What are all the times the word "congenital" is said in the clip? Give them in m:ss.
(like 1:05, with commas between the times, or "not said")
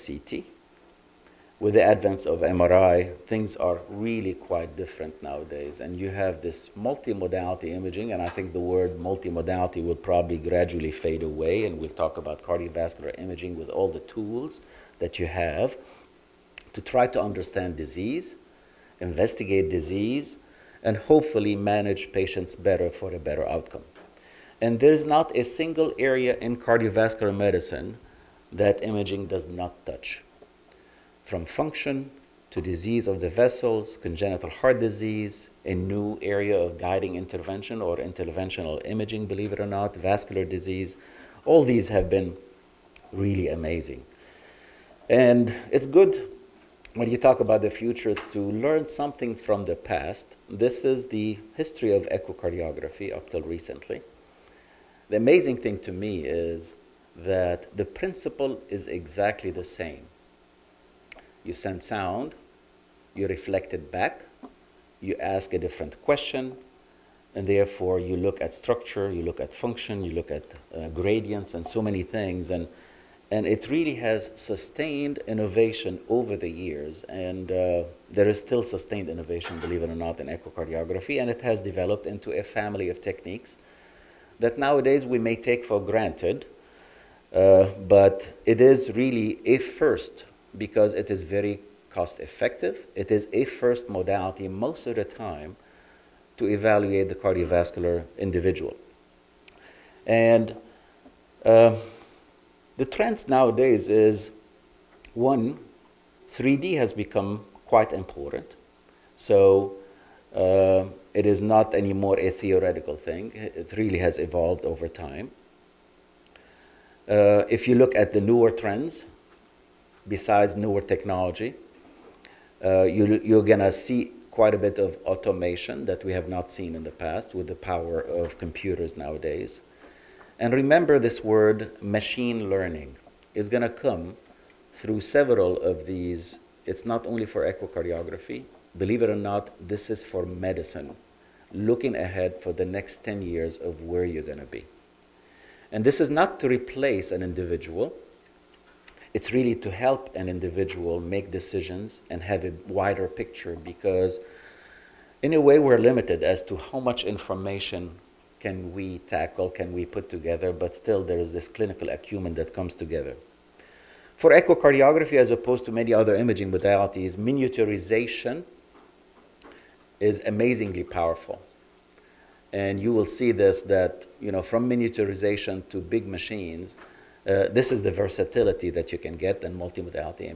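0:33.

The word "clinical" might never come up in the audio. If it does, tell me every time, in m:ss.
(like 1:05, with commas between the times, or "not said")
2:41.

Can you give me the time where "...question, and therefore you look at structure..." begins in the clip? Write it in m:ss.
1:06.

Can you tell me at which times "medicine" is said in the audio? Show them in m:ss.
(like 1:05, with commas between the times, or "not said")
0:27, 2:20.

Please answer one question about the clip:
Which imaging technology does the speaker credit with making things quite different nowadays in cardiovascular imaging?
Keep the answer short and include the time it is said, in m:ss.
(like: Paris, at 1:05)
MRI, at 0:02.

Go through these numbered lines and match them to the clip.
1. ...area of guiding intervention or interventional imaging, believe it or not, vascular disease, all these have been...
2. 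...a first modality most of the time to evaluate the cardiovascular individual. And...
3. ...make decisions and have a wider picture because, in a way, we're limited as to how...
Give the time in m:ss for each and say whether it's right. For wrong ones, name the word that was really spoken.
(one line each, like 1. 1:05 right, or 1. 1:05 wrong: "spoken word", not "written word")
1. 0:36 right
2. 1:33 right
3. 2:30 right.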